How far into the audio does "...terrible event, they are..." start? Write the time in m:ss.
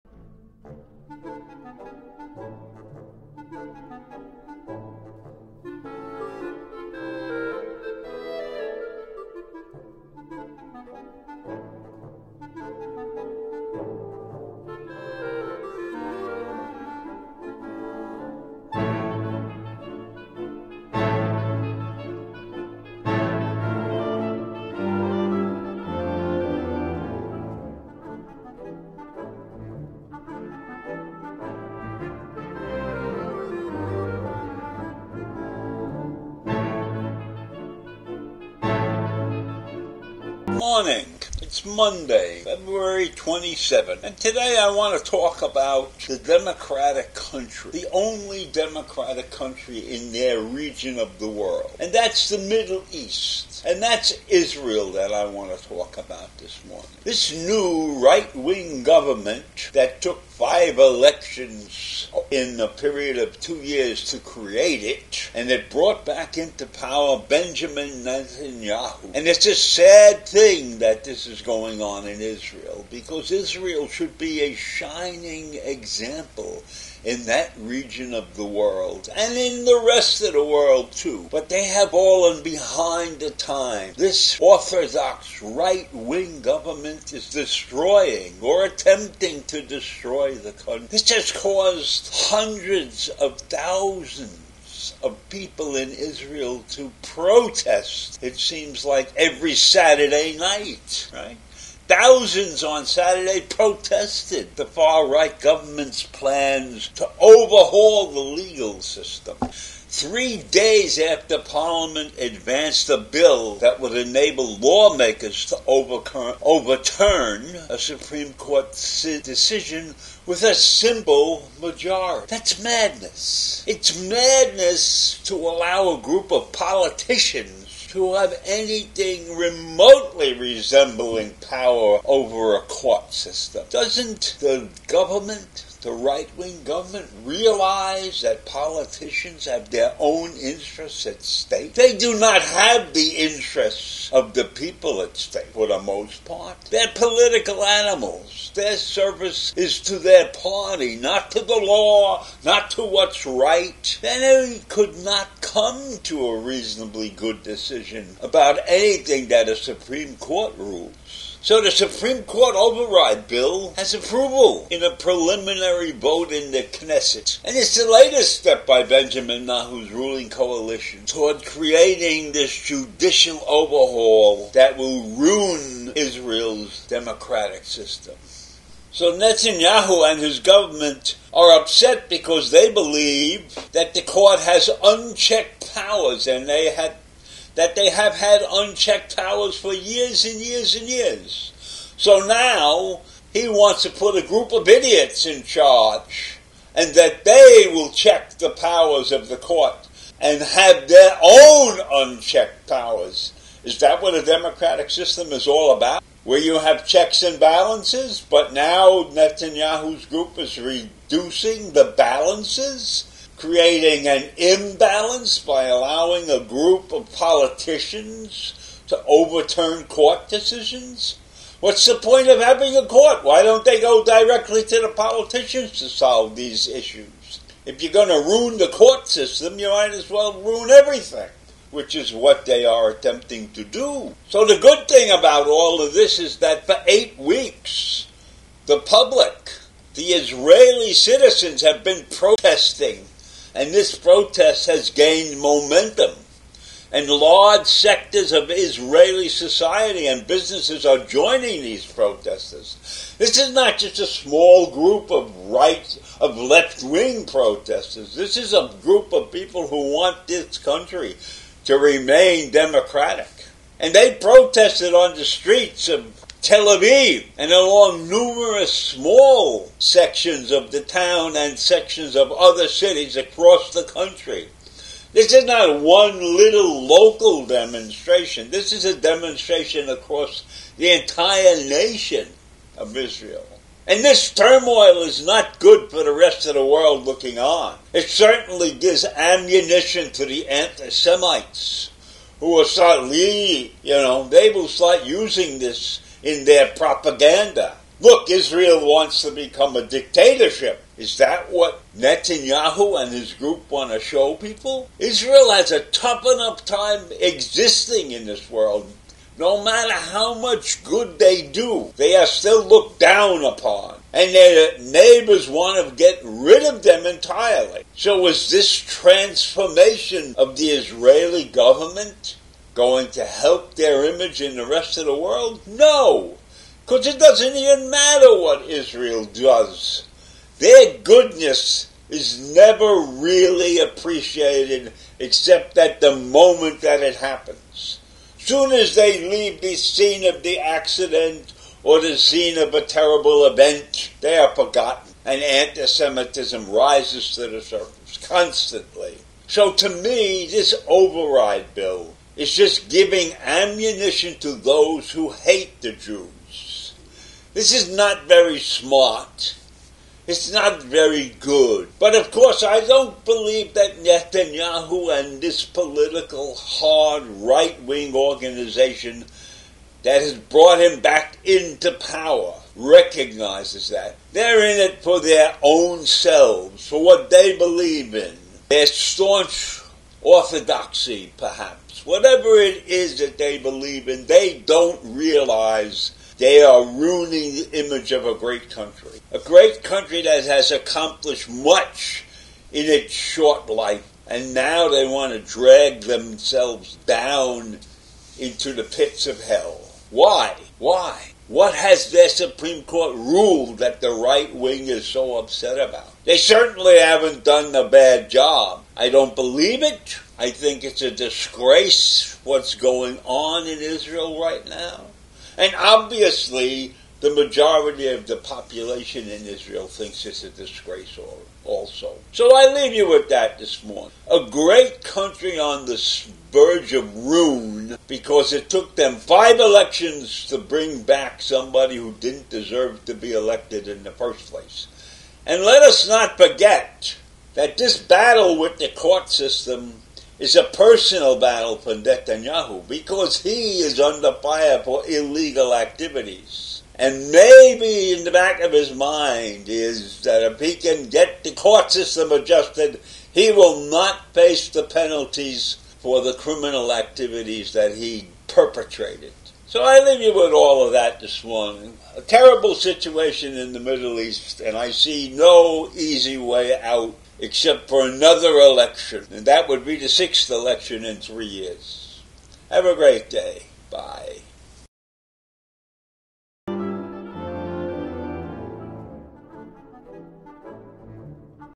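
5:42.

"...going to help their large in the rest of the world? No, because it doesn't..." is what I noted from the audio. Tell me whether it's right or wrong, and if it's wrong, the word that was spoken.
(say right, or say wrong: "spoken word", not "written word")
wrong: "image", not "large".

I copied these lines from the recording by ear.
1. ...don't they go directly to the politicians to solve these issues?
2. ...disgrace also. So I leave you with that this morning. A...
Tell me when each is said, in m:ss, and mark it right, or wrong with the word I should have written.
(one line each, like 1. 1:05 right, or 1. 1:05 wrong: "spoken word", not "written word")
1. 3:43 right
2. 7:00 right.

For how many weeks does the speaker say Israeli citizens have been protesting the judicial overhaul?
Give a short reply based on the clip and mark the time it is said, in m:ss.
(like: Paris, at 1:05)
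8, at 3:56.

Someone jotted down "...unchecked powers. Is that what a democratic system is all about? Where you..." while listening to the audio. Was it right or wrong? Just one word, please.
right.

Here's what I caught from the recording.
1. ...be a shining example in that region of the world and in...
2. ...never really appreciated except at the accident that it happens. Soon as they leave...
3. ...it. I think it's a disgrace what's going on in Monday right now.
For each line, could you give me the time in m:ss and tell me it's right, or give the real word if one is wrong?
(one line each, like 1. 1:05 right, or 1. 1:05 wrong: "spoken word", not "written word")
1. 1:14 right
2. 5:32 wrong: "moment", not "accident"
3. 6:49 wrong: "Israel", not "Monday".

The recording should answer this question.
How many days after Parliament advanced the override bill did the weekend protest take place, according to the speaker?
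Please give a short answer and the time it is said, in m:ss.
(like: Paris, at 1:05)
3, at 1:49.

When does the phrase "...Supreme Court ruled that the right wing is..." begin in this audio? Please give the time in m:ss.
6:42.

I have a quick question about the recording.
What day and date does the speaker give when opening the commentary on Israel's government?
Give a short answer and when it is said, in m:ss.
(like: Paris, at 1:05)
Monday, February 27, at 0:41.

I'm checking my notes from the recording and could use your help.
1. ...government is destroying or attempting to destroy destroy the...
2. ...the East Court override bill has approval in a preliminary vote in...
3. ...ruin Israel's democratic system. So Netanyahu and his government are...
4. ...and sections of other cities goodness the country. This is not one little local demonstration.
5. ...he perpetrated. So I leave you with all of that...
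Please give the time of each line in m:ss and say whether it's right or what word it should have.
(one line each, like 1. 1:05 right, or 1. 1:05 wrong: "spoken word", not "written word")
1. 1:26 right
2. 2:41 wrong: "Supreme", not "East"
3. 2:55 right
4. 4:31 wrong: "across", not "goodness"
5. 7:37 right.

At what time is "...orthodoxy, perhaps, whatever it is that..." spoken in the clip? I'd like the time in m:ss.
6:20.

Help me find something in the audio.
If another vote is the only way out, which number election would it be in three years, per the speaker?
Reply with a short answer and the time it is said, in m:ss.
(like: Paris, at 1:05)
6th, at 7:50.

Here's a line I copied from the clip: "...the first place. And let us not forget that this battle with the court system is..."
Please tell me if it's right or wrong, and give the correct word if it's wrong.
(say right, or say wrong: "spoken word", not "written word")
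right.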